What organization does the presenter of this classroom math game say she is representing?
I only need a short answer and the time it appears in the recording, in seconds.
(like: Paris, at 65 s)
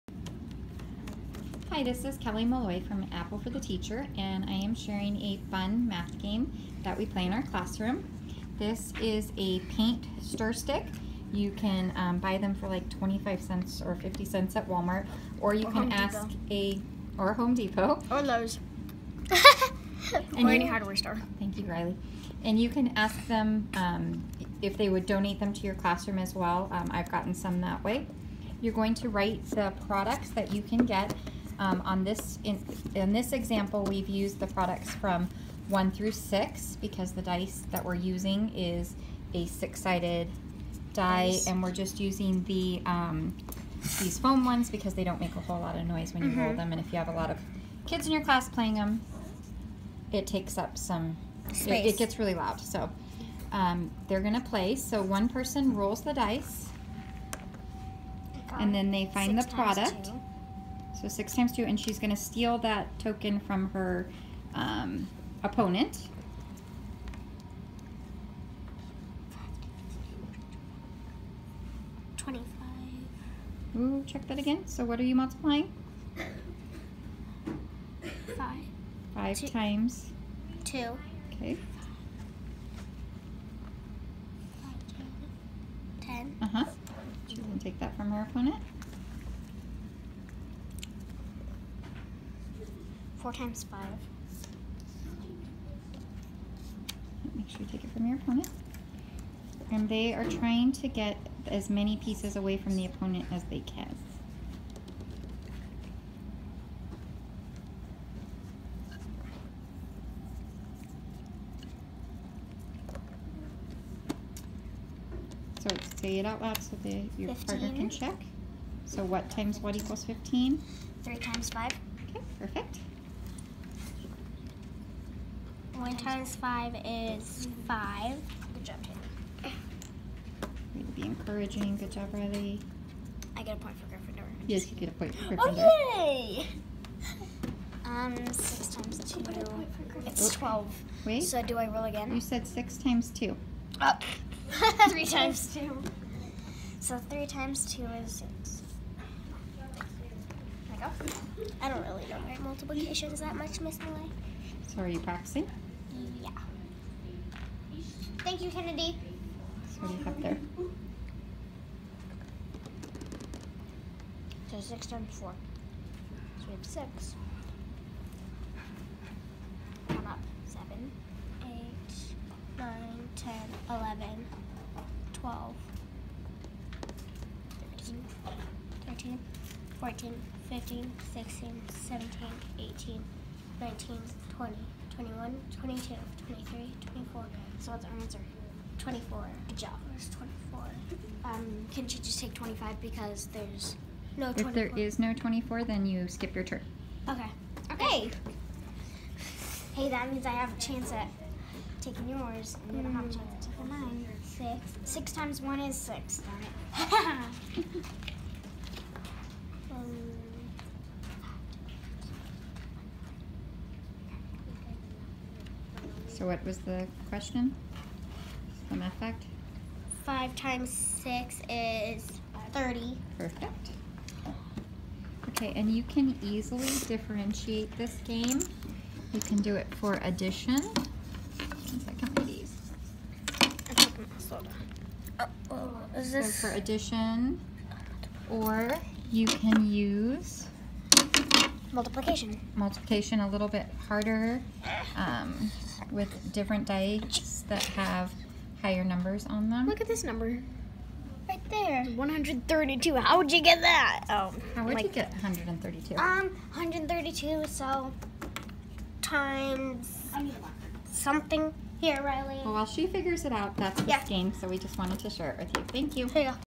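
Apple for the Teacher, at 3 s.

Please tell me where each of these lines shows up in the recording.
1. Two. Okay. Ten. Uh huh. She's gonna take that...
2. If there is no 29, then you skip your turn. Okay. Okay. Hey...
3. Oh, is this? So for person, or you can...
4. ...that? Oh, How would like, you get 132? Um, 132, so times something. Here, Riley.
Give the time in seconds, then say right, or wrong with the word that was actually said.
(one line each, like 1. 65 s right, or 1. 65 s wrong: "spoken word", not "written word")
1. 80 s right
2. 194 s wrong: "24", not "29"
3. 235 s wrong: "addition", not "person"
4. 253 s right.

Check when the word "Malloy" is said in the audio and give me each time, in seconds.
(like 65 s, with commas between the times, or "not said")
2 s, 153 s.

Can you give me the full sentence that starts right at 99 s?
And they are trying to get as many pieces away from the opponent as they can.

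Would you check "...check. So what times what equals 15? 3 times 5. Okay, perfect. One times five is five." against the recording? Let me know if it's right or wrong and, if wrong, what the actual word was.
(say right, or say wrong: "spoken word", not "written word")
right.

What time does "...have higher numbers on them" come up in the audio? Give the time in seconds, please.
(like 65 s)
247 s.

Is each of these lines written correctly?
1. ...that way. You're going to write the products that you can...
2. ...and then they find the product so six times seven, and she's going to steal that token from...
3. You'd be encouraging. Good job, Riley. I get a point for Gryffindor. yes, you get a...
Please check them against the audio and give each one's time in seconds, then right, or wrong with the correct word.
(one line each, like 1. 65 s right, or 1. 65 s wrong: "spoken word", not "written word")
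1. 27 s right
2. 58 s wrong: "two", not "seven"
3. 130 s right.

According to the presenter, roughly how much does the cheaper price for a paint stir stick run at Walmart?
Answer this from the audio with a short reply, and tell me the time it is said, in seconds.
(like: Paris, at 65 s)
25 cents, at 12 s.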